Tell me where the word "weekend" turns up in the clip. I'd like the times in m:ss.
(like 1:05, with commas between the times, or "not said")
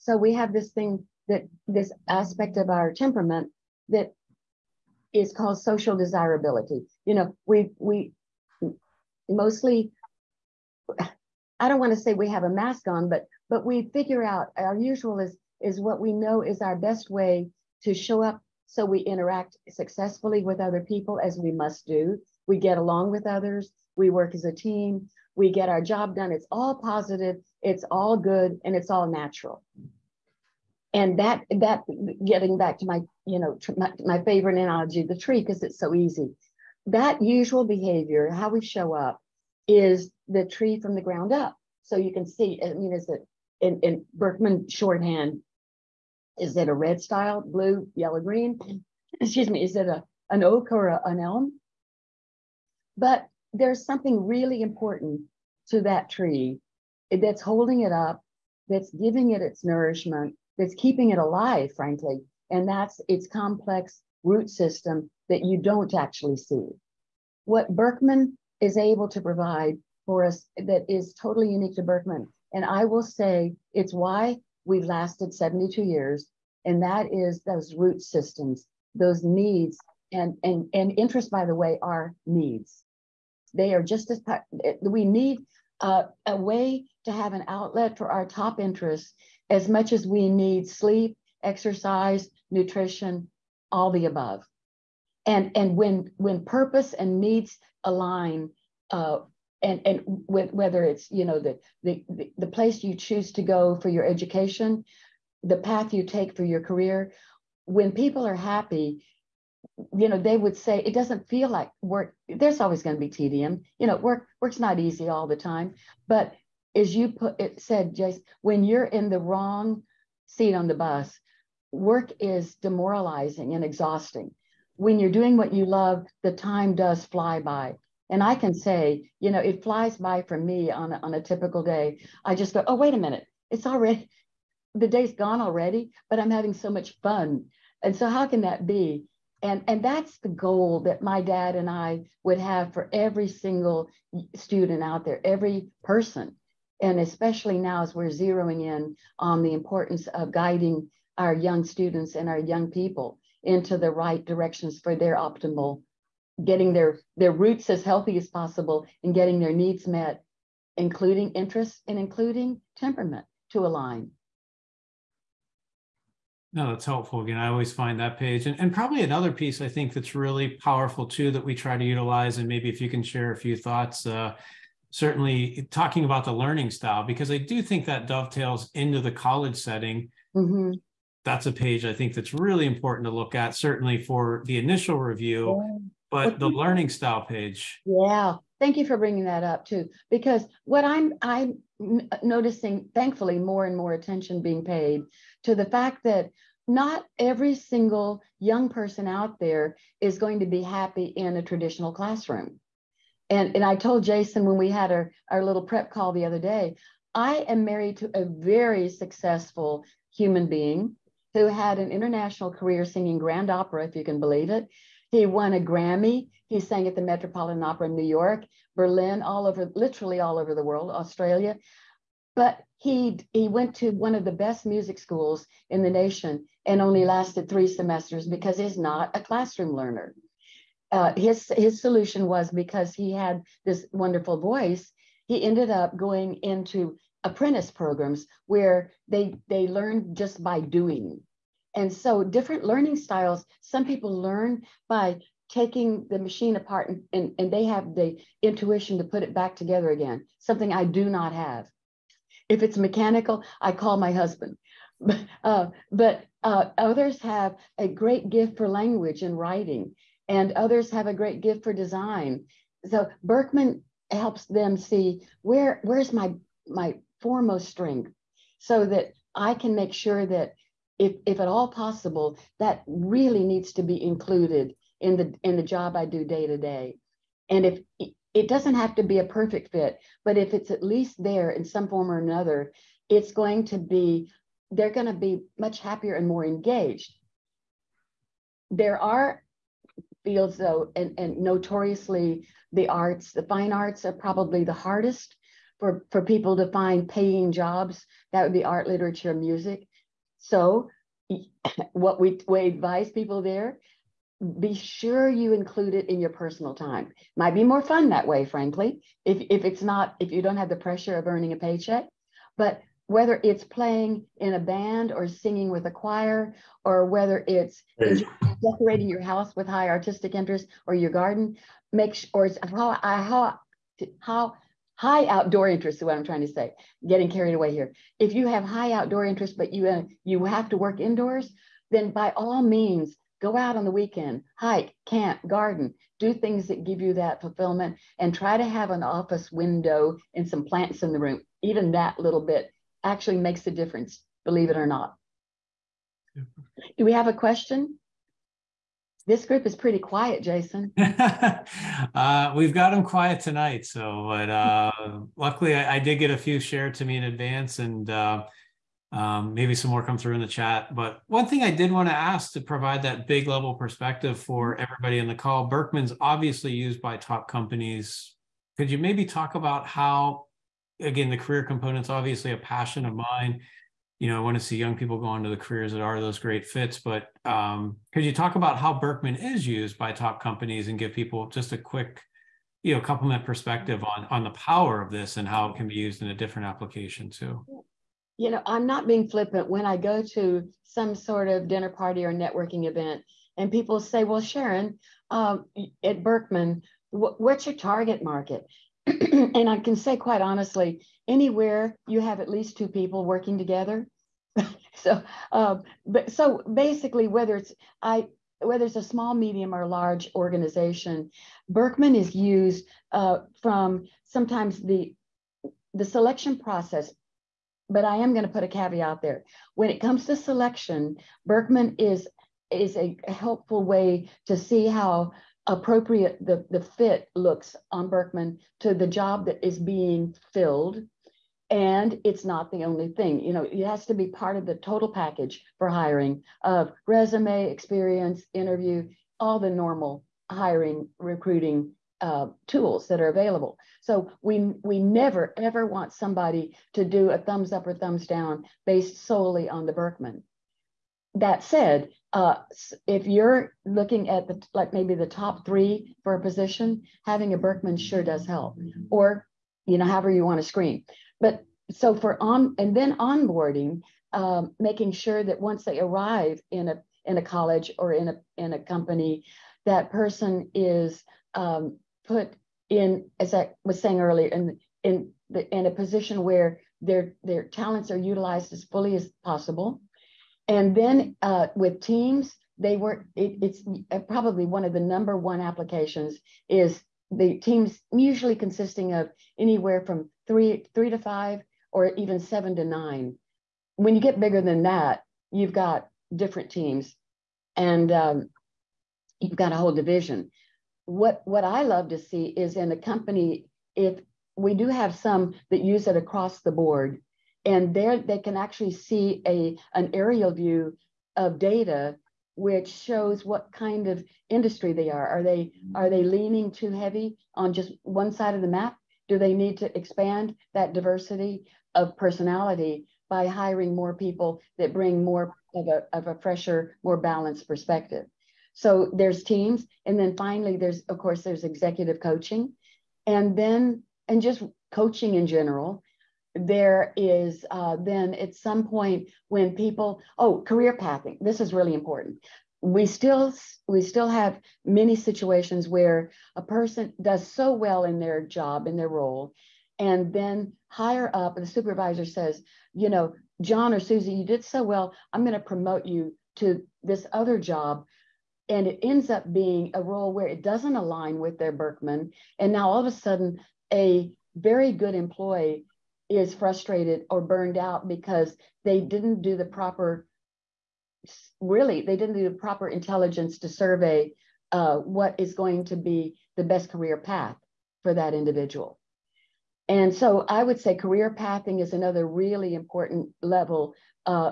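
5:33.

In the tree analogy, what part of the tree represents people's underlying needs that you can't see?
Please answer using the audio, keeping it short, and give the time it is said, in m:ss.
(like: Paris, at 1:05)
root system, at 1:03.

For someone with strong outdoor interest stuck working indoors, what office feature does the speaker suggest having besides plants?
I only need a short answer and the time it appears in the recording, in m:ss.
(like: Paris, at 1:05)
an office window, at 5:39.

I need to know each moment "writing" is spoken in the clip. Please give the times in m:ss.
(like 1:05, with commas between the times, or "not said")
4:19.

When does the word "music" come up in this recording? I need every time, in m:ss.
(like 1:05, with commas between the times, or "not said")
3:44, 4:59.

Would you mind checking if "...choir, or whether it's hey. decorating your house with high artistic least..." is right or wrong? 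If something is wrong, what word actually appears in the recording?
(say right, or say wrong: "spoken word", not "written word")
wrong: "interest", not "least".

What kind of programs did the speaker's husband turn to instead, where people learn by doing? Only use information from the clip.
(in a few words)
apprentice programs.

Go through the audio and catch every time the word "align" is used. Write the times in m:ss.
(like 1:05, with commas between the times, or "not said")
1:37, 2:43, 9:20.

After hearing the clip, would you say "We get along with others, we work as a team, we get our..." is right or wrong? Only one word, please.
right.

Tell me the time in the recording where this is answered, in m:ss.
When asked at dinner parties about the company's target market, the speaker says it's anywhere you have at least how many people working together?
6:42.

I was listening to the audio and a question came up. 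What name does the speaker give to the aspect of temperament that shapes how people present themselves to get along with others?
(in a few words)
social desirability.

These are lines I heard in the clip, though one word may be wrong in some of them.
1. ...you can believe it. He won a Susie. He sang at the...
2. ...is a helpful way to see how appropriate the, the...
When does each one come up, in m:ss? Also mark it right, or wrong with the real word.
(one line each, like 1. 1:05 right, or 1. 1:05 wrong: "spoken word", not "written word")
1. 3:33 wrong: "Grammy", not "Susie"
2. 7:02 right.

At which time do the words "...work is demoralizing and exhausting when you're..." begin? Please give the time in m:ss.
2:01.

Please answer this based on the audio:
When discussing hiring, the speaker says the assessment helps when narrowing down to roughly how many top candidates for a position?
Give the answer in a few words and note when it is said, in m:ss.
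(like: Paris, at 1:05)
top 3, at 7:35.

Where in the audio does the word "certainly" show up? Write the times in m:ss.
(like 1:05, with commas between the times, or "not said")
2:54, 3:03.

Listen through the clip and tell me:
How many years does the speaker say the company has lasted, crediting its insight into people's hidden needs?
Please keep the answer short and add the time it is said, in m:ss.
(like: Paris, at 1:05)
72, at 1:15.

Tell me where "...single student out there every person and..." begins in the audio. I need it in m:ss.
2:23.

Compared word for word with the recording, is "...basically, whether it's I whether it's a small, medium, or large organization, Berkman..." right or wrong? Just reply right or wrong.
right.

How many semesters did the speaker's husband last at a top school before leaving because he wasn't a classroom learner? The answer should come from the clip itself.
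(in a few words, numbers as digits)
3.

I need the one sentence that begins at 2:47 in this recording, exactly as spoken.
Again, I always find that page.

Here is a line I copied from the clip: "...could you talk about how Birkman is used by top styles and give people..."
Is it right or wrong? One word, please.
wrong.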